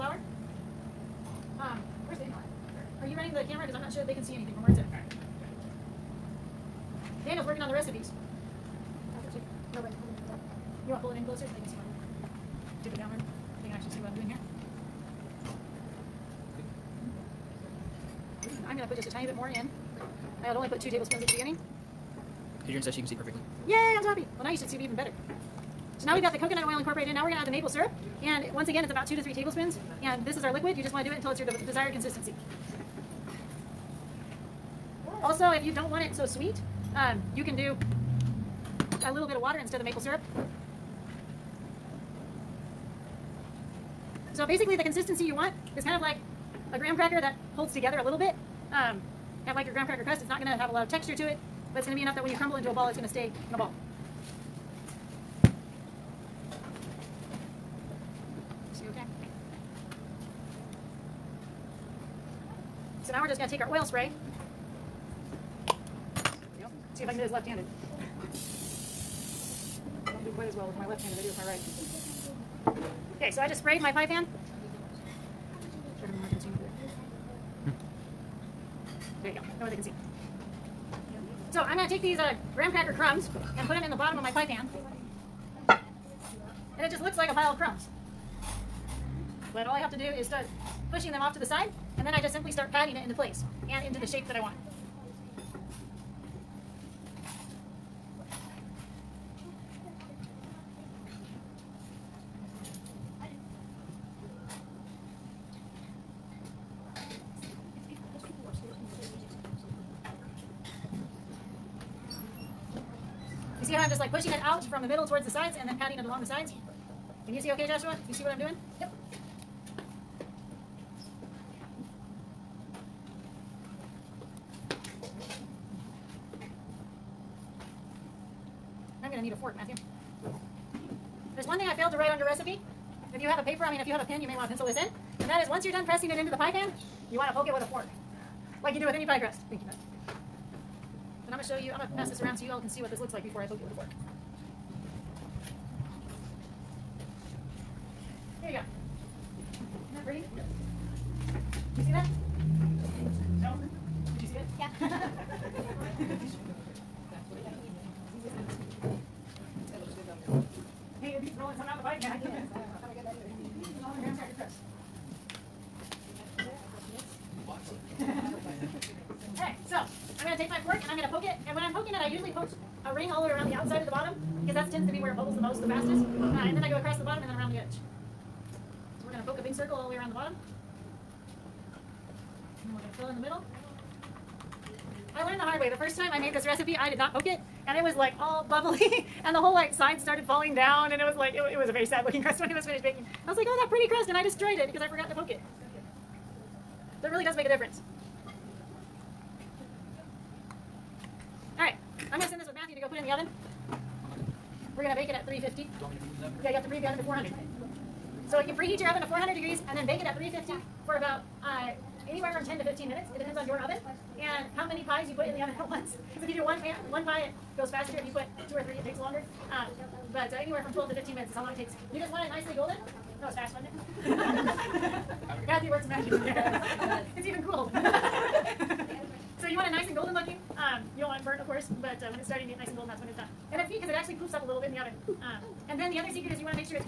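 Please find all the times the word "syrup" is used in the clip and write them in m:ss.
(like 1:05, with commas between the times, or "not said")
0:27, 0:40.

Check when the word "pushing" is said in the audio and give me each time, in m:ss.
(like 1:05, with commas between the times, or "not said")
1:30, 1:54.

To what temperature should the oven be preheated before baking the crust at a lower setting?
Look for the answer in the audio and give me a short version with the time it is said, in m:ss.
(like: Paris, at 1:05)
400 degrees, at 3:29.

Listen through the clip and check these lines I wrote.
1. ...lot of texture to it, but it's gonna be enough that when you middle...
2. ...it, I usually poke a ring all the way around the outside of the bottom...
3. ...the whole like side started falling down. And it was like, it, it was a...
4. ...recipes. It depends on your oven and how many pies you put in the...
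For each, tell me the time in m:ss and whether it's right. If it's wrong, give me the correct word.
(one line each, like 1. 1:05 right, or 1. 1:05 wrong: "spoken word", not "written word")
1. 0:50 wrong: "crumble", not "middle"
2. 2:51 right
3. 3:09 right
4. 3:32 wrong: "minutes", not "recipes".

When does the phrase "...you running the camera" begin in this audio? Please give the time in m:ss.
0:03.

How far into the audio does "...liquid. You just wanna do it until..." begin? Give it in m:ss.
0:30.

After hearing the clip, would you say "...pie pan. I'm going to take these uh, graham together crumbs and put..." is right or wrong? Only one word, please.
wrong.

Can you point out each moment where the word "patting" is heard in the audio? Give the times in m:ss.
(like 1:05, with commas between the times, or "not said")
1:32, 1:55.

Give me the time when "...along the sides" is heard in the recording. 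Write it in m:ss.
1:56.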